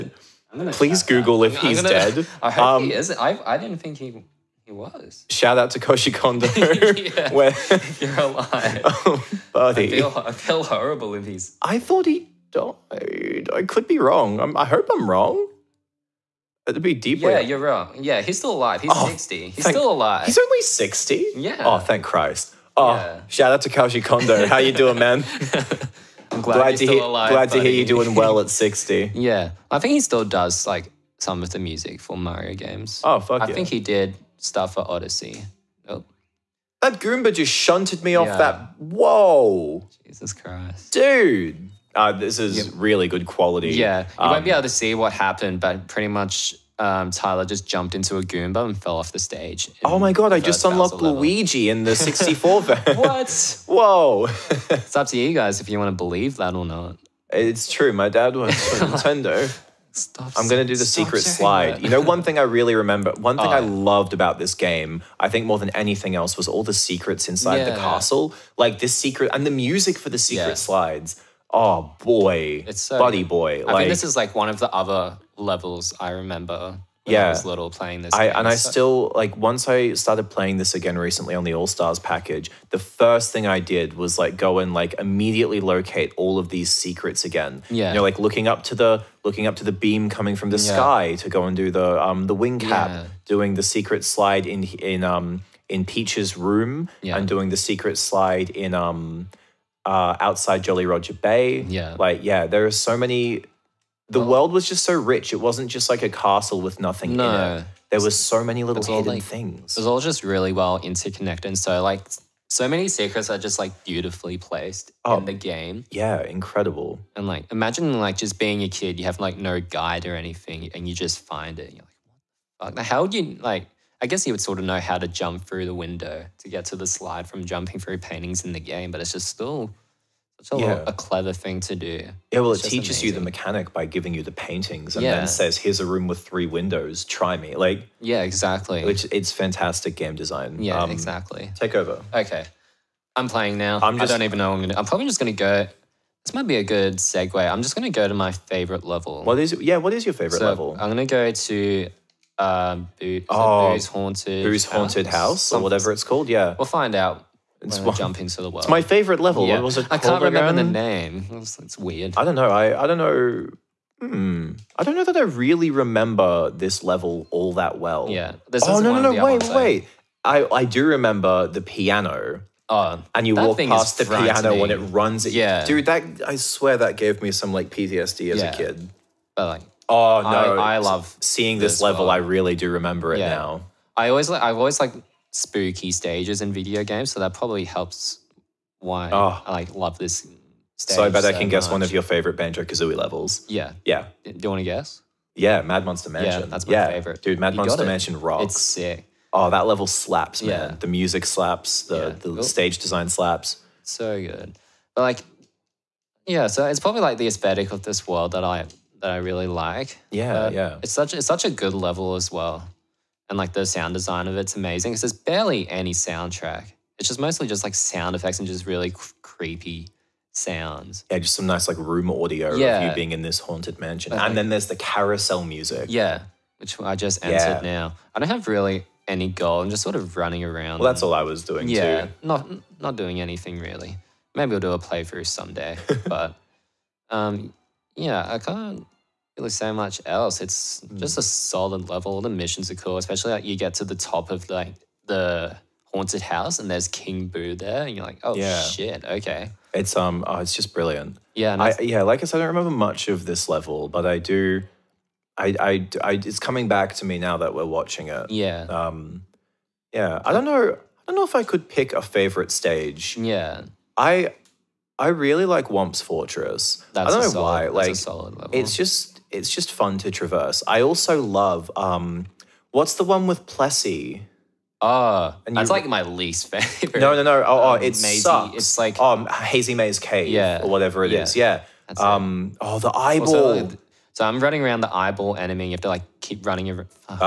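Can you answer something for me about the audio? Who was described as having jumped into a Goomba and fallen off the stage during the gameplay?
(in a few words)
Tyler.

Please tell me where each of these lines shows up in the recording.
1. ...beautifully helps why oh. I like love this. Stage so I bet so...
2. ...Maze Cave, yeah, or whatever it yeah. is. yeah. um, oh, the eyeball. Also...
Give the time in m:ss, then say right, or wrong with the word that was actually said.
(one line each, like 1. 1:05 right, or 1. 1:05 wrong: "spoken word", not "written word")
1. 3:07 wrong: "probably", not "beautifully"
2. 4:39 right.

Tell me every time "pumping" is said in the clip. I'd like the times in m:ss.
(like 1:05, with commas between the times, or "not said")
not said.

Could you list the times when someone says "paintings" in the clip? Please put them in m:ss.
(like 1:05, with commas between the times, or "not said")
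2:07, 2:14.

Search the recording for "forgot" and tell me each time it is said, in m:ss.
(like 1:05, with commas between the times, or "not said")
not said.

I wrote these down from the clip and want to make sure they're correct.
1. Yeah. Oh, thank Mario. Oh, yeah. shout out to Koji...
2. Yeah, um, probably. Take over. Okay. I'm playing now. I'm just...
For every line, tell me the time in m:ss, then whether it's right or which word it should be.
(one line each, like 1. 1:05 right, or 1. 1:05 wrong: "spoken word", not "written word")
1. 0:21 wrong: "Christ", not "Mario"
2. 2:20 wrong: "exactly", not "probably".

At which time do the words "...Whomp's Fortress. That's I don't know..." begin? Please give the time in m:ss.
4:25.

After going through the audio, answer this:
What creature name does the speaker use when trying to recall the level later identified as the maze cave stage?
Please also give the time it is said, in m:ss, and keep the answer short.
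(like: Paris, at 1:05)
Plessy, at 4:33.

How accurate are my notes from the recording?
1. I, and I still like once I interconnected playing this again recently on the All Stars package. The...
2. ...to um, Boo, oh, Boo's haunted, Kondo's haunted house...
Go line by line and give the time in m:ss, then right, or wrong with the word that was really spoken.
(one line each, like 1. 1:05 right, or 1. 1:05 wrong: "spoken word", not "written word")
1. 1:18 wrong: "started", not "interconnected"
2. 2:31 wrong: "Boo", not "Kondo".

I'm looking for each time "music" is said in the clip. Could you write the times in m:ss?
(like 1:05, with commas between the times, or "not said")
0:31, 1:09, 3:20, 3:45.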